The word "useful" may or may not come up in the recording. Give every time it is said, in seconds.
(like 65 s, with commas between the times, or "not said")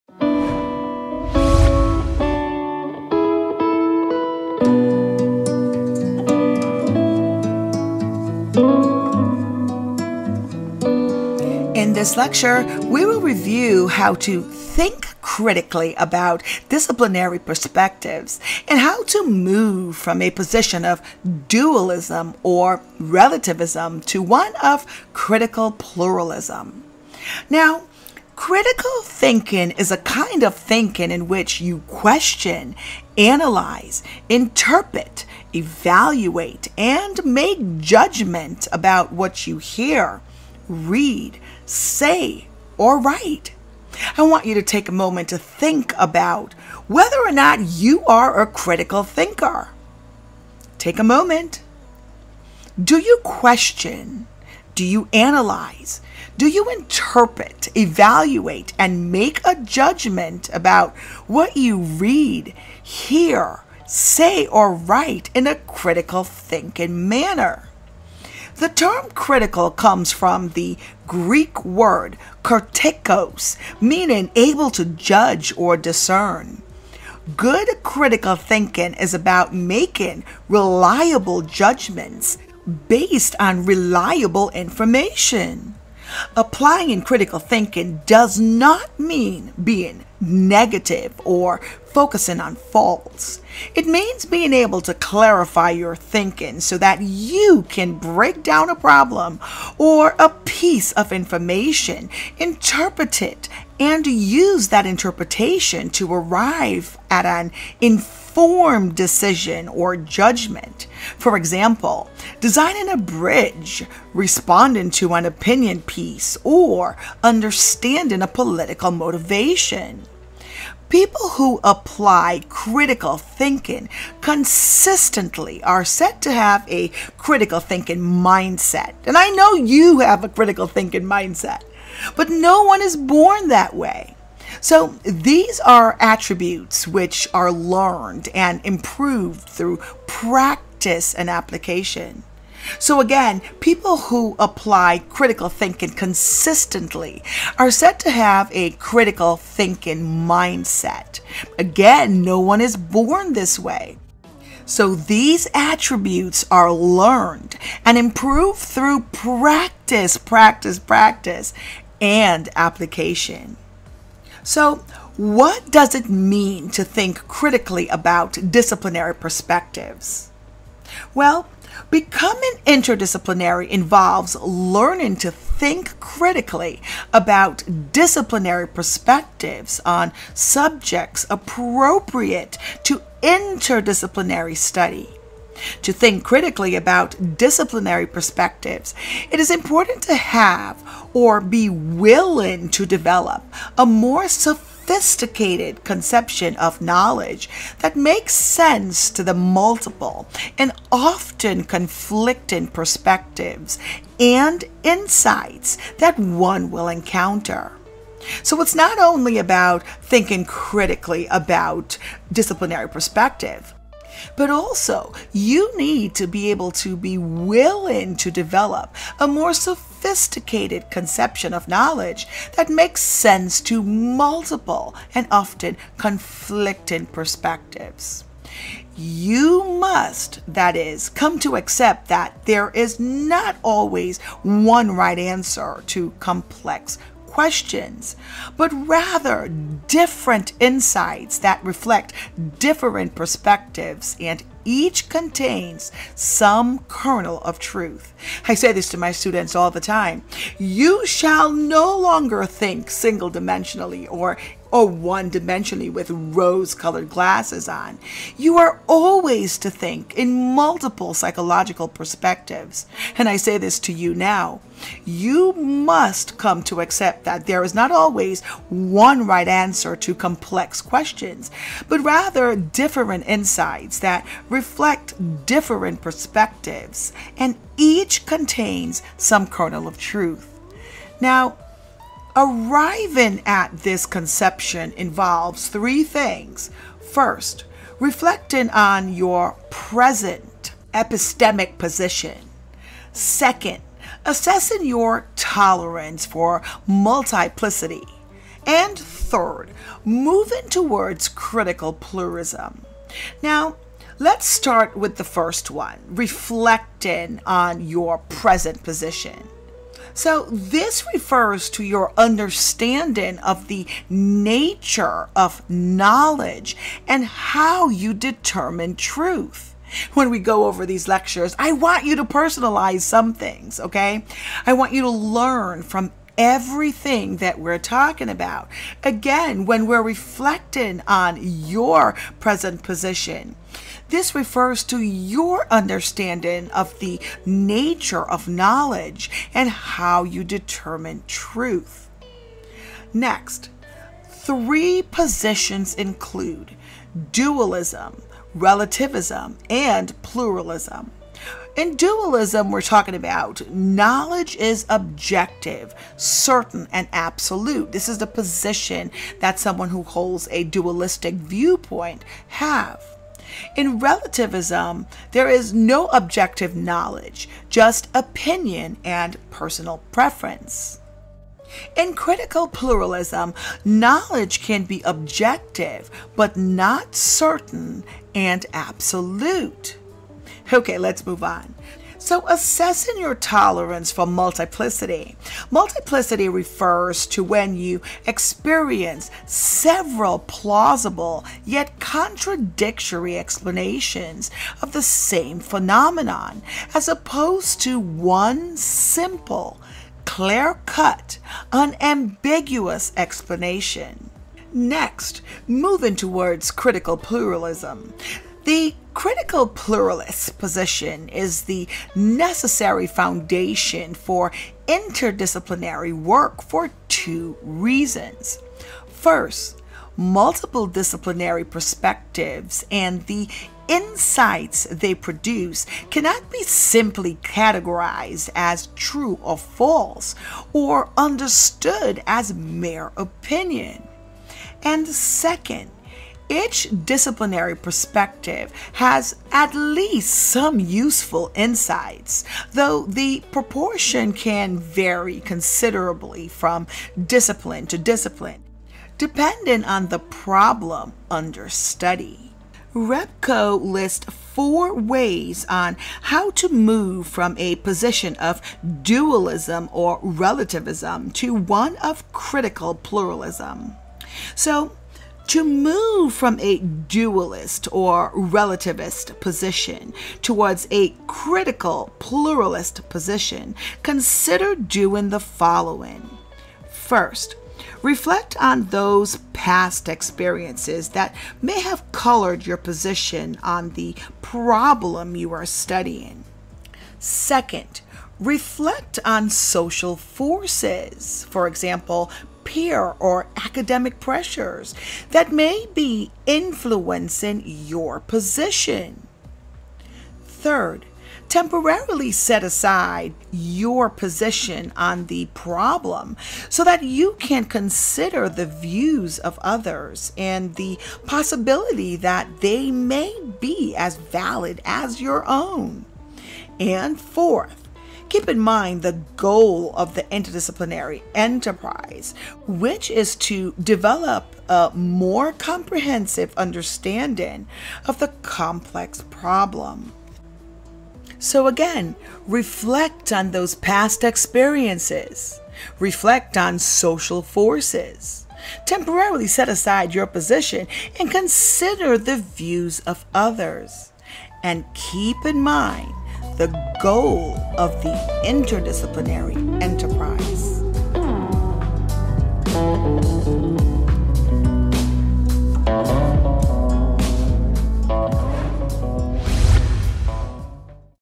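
440 s.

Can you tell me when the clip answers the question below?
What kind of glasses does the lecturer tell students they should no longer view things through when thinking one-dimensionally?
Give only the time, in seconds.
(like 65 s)
256 s.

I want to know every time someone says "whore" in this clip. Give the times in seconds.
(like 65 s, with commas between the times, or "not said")
not said.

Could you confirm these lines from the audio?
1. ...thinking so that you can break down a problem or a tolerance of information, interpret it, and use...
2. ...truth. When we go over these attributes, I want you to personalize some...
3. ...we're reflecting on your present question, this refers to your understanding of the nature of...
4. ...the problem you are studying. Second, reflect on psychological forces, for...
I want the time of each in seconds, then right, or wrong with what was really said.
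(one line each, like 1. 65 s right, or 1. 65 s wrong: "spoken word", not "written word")
1. 95 s wrong: "piece", not "tolerance"
2. 318 s wrong: "lectures", not "attributes"
3. 329 s wrong: "position", not "question"
4. 483 s wrong: "social", not "psychological".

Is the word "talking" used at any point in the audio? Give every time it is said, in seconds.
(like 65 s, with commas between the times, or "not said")
327 s, 352 s.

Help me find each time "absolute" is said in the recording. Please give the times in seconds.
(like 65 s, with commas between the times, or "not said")
357 s, 378 s.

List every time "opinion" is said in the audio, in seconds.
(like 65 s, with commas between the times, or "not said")
115 s, 368 s, 433 s.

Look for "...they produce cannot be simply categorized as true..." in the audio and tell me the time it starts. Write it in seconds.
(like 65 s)
424 s.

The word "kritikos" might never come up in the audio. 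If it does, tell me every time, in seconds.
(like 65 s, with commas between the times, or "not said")
72 s.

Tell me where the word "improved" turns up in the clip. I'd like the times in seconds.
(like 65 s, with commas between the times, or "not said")
138 s, 157 s.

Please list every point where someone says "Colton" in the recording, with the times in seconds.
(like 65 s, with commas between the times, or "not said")
not said.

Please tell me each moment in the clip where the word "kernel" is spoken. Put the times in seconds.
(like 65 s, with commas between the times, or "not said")
246 s, 279 s.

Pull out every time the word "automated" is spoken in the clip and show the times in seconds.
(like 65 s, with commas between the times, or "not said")
not said.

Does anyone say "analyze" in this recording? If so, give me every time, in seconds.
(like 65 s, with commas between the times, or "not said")
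33 s, 55 s.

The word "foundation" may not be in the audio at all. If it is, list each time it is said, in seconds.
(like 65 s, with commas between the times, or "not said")
413 s.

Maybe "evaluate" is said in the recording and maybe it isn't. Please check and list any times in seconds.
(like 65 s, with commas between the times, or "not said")
35 s, 57 s.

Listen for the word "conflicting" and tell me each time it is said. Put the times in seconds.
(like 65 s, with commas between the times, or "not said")
201 s, 225 s.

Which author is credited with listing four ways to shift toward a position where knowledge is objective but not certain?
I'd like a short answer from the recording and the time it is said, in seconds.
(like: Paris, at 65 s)
Repko, at 452 s.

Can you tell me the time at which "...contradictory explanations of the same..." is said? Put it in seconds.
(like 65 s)
391 s.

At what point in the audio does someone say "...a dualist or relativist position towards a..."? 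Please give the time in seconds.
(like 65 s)
466 s.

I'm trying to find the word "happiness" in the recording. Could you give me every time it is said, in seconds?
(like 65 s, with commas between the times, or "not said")
not said.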